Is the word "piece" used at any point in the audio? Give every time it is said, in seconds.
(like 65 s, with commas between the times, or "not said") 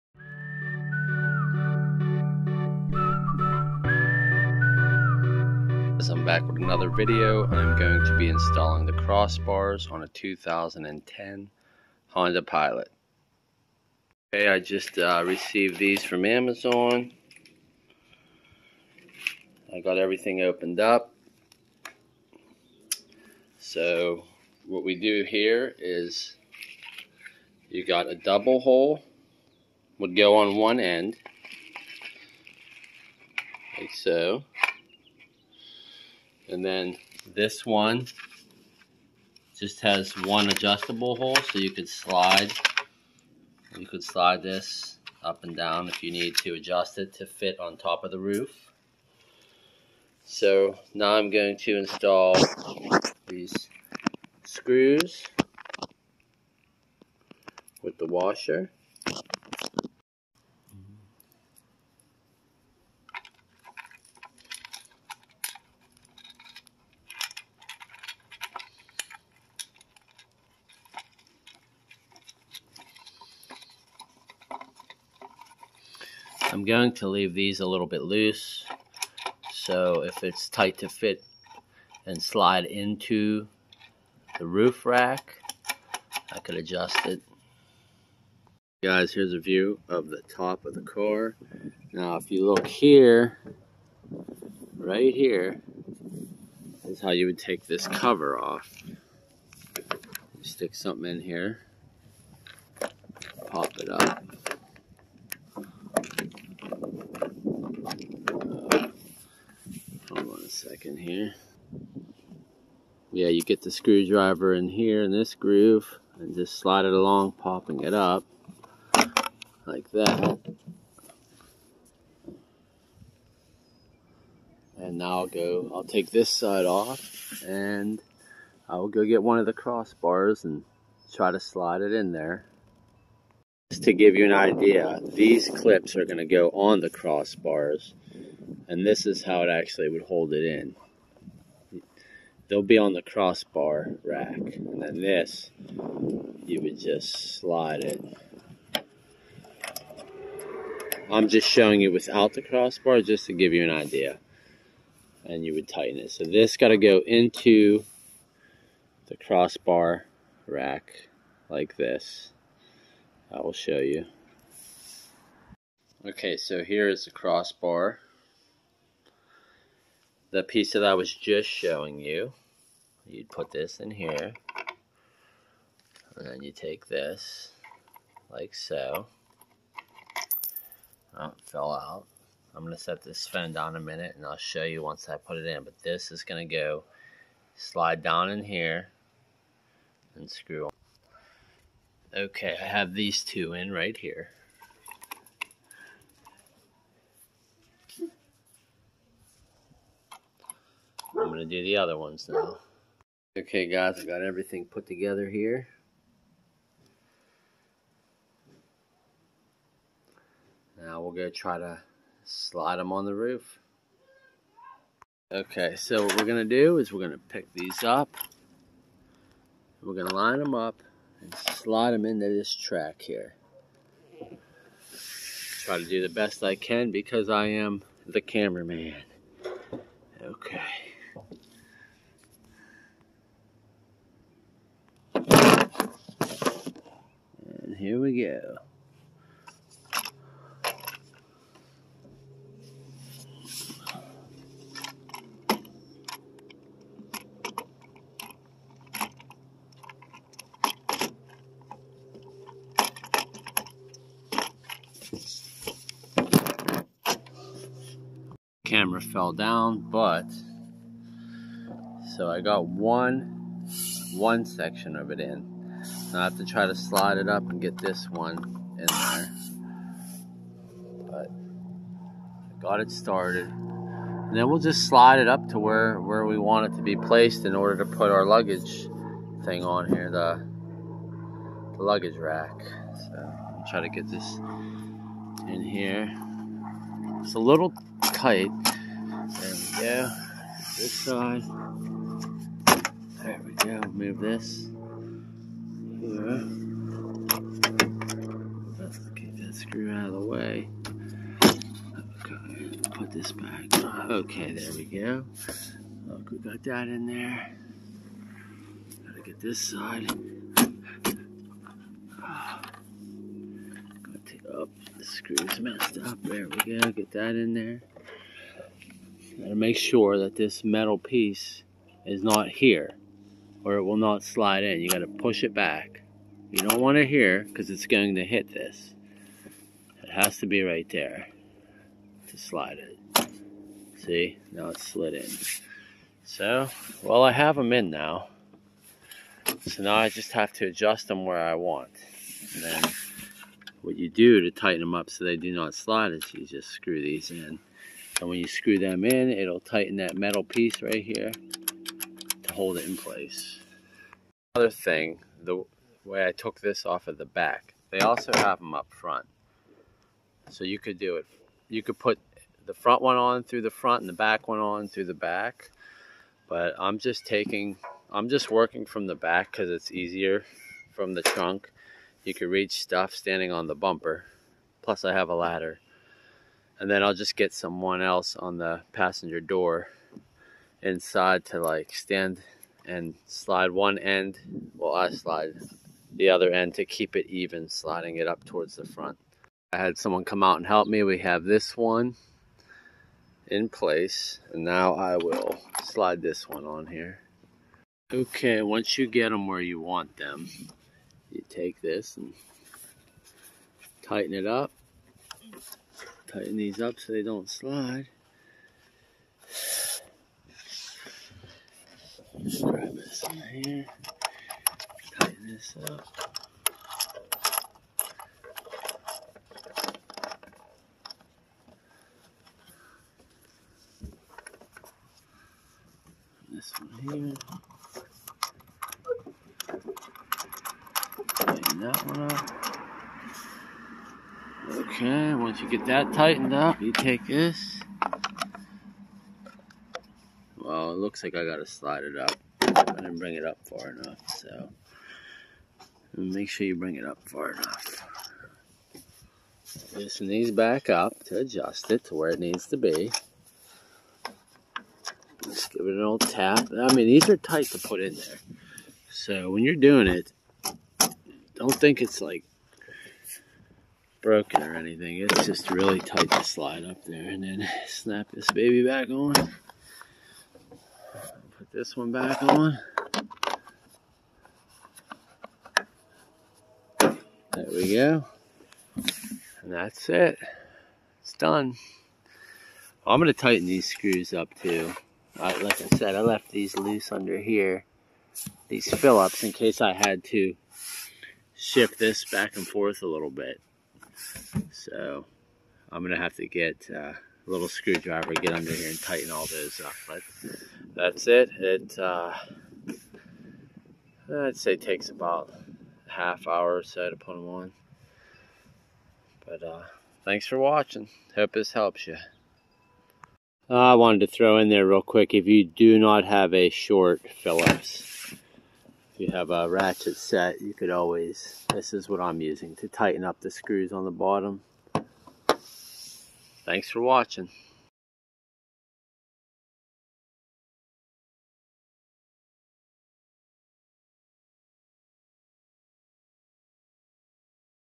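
170 s, 320 s, 350 s.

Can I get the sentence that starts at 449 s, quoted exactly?
Loosen these back up to adjust it to where it needs to be.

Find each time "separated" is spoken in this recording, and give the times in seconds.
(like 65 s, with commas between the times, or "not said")
not said.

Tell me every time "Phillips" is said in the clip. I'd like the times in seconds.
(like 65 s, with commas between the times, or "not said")
488 s, 517 s.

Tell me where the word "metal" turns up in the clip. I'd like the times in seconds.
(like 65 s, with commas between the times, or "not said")
320 s, 350 s.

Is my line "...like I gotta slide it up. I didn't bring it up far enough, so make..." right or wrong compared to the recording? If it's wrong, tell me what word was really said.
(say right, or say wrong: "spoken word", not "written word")
right.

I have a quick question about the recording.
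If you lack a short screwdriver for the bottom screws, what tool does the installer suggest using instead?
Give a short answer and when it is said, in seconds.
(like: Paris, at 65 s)
ratchet set, at 519 s.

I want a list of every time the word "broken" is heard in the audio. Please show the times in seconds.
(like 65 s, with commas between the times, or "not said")
464 s.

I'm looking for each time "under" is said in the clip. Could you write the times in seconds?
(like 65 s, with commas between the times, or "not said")
487 s, 498 s.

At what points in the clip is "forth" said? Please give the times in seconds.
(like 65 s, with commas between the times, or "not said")
492 s.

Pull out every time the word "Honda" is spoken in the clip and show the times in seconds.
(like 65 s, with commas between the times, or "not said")
12 s.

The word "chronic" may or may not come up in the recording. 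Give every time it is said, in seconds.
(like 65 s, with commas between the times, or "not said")
not said.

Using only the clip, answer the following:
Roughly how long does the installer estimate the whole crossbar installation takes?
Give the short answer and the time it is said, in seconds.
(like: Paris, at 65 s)
half hour, at 506 s.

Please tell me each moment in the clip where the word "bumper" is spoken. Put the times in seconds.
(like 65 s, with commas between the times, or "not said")
373 s.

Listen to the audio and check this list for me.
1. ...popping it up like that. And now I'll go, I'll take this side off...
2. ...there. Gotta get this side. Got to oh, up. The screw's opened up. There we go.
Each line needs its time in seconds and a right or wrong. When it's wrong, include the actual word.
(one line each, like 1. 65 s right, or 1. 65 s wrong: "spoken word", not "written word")
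1. 117 s right
2. 307 s wrong: "messed", not "opened".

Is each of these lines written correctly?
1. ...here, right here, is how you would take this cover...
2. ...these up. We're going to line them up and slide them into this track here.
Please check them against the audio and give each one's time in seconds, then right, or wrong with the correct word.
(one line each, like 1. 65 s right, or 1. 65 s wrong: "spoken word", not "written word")
1. 92 s right
2. 217 s right.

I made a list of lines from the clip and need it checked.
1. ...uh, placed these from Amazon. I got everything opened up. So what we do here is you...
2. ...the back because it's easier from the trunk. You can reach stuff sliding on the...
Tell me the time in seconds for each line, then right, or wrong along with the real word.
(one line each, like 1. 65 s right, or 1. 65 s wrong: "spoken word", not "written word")
1. 14 s wrong: "received", not "placed"
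2. 369 s wrong: "standing", not "sliding".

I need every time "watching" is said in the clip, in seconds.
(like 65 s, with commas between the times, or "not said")
510 s, 526 s.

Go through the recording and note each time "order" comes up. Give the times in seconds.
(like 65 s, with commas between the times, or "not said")
277 s.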